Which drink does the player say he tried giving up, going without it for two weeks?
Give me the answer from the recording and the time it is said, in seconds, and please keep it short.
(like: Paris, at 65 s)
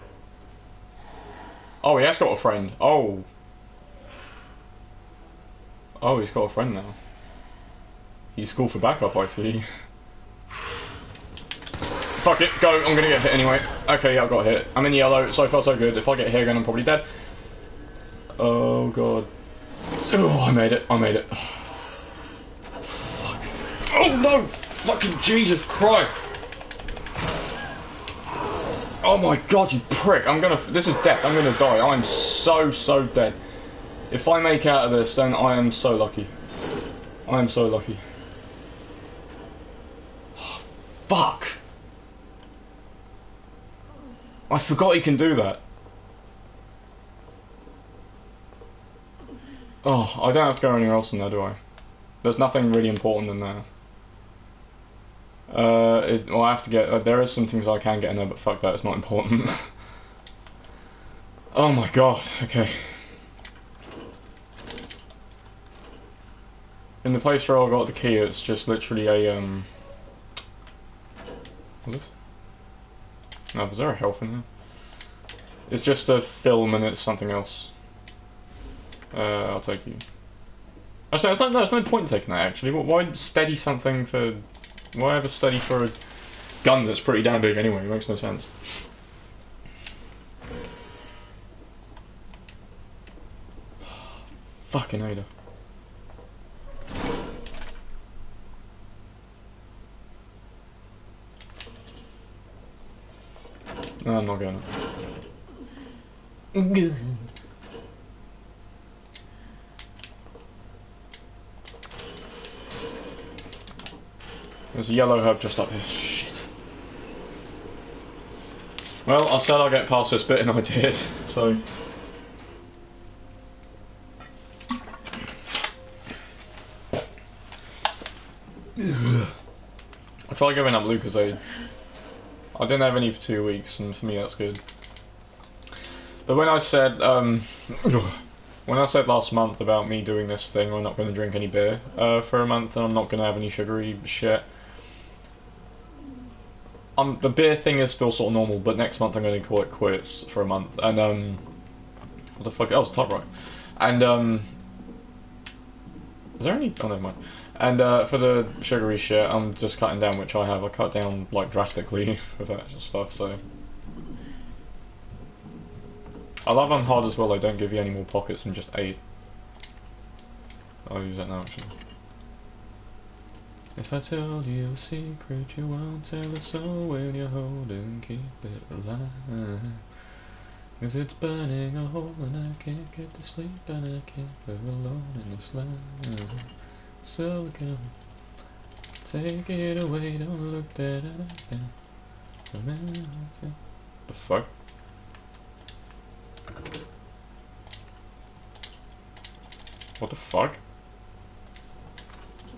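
Lucozade, at 130 s.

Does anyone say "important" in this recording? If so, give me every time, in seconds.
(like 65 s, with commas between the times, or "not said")
52 s, 58 s.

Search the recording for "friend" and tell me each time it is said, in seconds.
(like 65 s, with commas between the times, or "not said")
2 s, 6 s.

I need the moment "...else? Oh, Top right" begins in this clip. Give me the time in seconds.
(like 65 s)
152 s.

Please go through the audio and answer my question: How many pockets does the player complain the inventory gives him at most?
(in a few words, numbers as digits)
8.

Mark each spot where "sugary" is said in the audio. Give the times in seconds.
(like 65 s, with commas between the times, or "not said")
143 s, 158 s.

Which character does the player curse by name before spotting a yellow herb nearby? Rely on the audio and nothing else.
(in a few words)
Ada.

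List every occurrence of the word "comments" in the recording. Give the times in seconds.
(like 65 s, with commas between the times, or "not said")
not said.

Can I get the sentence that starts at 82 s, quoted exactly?
Why steady something for why a study for a gun that's pretty damn big anyway?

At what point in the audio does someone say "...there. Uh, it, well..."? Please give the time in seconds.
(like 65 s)
53 s.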